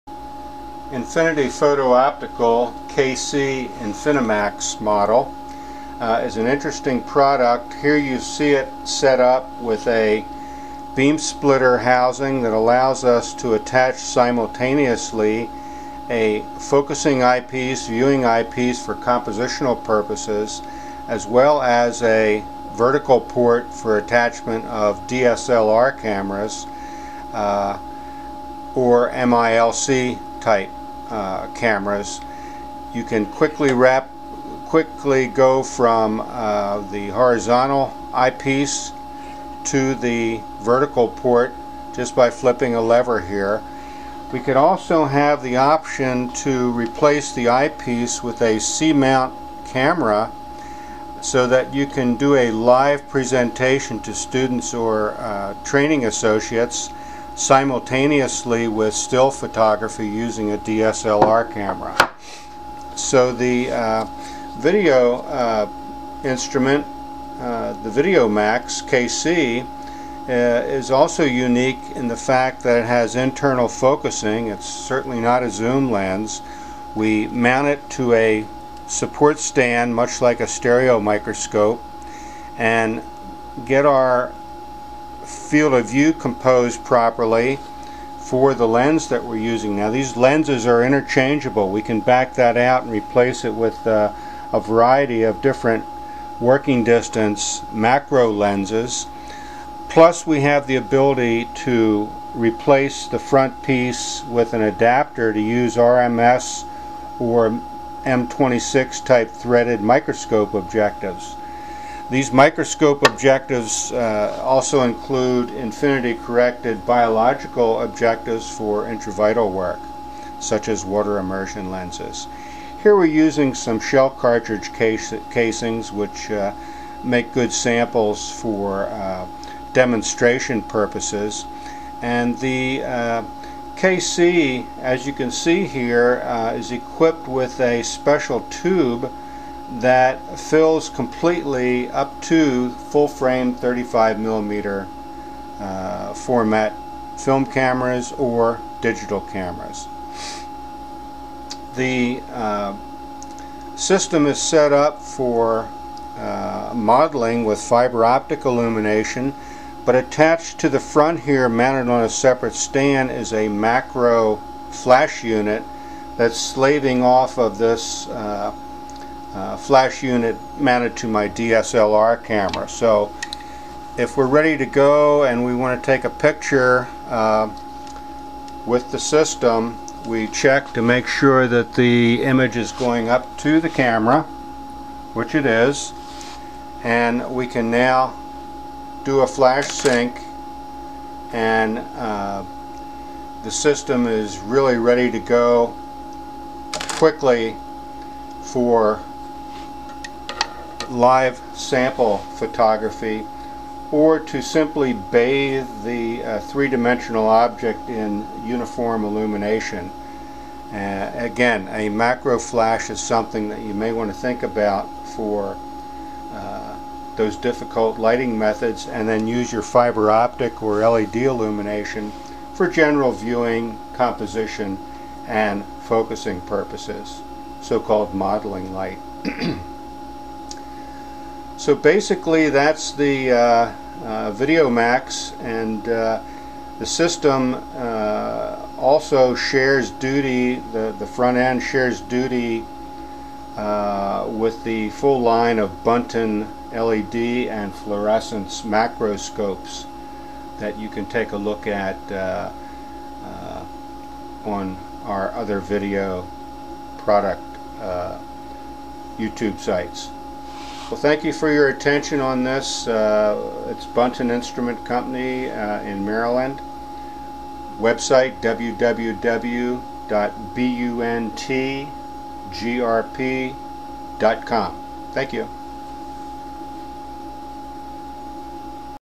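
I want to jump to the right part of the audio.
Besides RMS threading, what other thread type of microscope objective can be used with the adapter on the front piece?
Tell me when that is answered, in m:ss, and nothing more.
1:48.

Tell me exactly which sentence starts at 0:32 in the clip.
You can quickly wrap, quickly go from uh, the horizontal eyepiece to the vertical port just by flipping a lever here.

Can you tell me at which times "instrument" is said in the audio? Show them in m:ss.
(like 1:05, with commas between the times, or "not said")
1:06, 4:24.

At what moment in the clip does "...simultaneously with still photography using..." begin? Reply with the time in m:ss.
0:57.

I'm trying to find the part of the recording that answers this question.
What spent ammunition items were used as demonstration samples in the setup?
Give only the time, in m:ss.
2:03.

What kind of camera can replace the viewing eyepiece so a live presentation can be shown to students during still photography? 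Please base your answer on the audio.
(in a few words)
C-mount camera.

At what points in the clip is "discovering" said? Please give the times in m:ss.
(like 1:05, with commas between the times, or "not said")
not said.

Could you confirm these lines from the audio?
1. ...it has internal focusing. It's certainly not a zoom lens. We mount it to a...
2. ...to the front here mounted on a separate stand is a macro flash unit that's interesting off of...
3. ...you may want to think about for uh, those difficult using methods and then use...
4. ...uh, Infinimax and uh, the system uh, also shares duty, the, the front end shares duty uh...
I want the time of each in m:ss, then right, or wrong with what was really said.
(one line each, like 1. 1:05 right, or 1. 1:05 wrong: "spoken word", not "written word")
1. 1:12 right
2. 2:40 wrong: "slaving", not "interesting"
3. 3:33 wrong: "lighting", not "using"
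4. 3:53 wrong: "VideoMax", not "Infinimax".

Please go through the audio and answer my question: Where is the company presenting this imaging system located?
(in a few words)
Maryland.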